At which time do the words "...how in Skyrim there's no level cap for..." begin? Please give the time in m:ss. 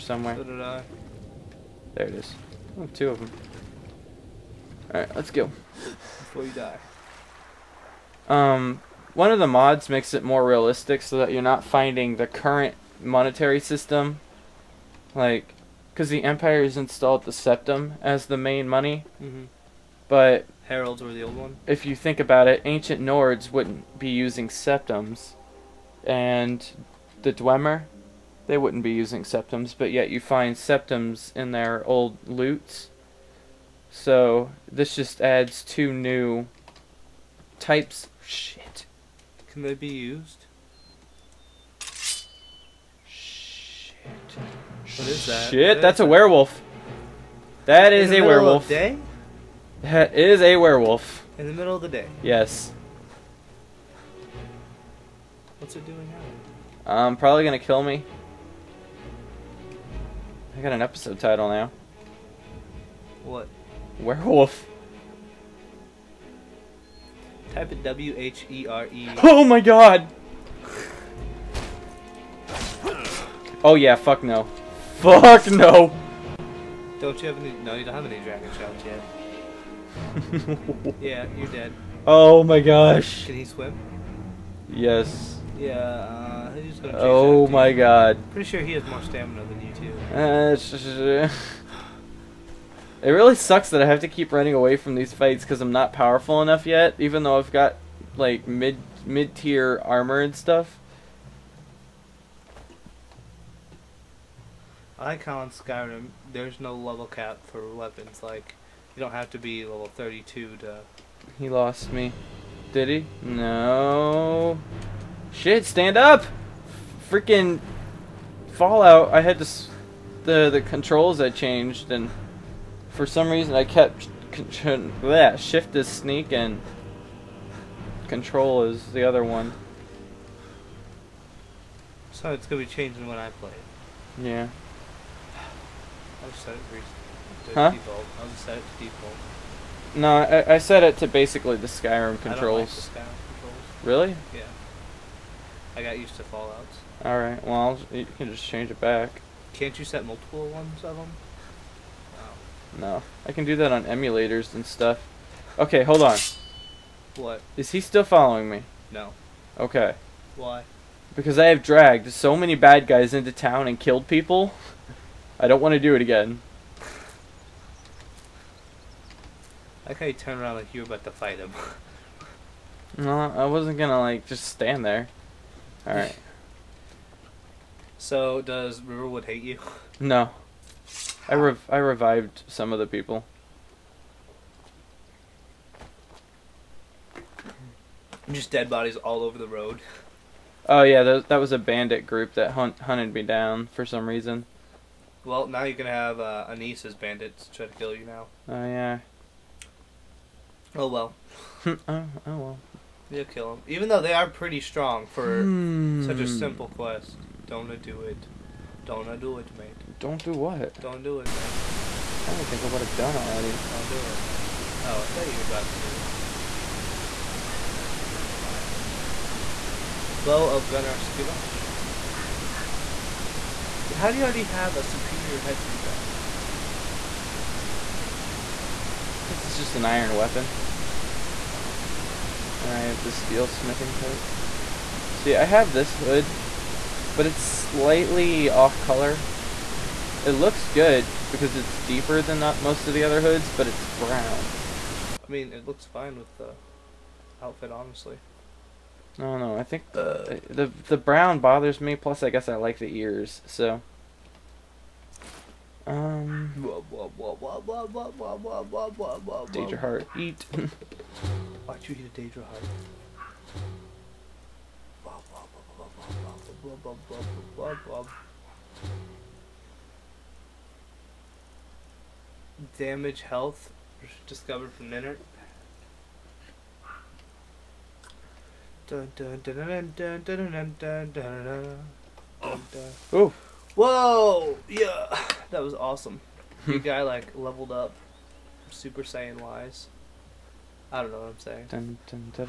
1:45.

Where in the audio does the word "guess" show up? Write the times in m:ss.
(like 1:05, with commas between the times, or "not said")
4:12.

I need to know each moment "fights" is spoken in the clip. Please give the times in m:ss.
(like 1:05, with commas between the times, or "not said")
1:35, 2:51.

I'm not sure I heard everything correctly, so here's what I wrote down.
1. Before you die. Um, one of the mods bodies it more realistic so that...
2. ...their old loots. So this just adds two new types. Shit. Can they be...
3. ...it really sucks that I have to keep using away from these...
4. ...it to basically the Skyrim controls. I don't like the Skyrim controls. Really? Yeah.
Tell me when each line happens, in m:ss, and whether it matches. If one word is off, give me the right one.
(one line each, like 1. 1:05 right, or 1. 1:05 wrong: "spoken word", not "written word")
1. 0:05 wrong: "makes", not "bodies"
2. 0:31 right
3. 1:33 wrong: "running", not "using"
4. 2:20 right.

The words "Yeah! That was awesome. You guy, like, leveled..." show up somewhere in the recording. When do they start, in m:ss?
4:44.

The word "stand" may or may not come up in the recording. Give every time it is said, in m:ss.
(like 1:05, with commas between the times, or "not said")
1:55, 2:54.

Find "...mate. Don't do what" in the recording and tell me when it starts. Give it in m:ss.
3:29.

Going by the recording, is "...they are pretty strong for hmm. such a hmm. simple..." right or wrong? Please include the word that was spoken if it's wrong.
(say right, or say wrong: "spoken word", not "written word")
right.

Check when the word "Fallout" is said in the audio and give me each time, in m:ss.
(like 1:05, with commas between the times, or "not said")
1:58, 2:26.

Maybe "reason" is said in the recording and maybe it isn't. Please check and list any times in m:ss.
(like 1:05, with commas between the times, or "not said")
2:03, 3:14.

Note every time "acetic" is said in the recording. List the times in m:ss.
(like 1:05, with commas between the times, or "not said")
not said.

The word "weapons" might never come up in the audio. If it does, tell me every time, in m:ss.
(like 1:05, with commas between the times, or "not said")
1:47, 3:50.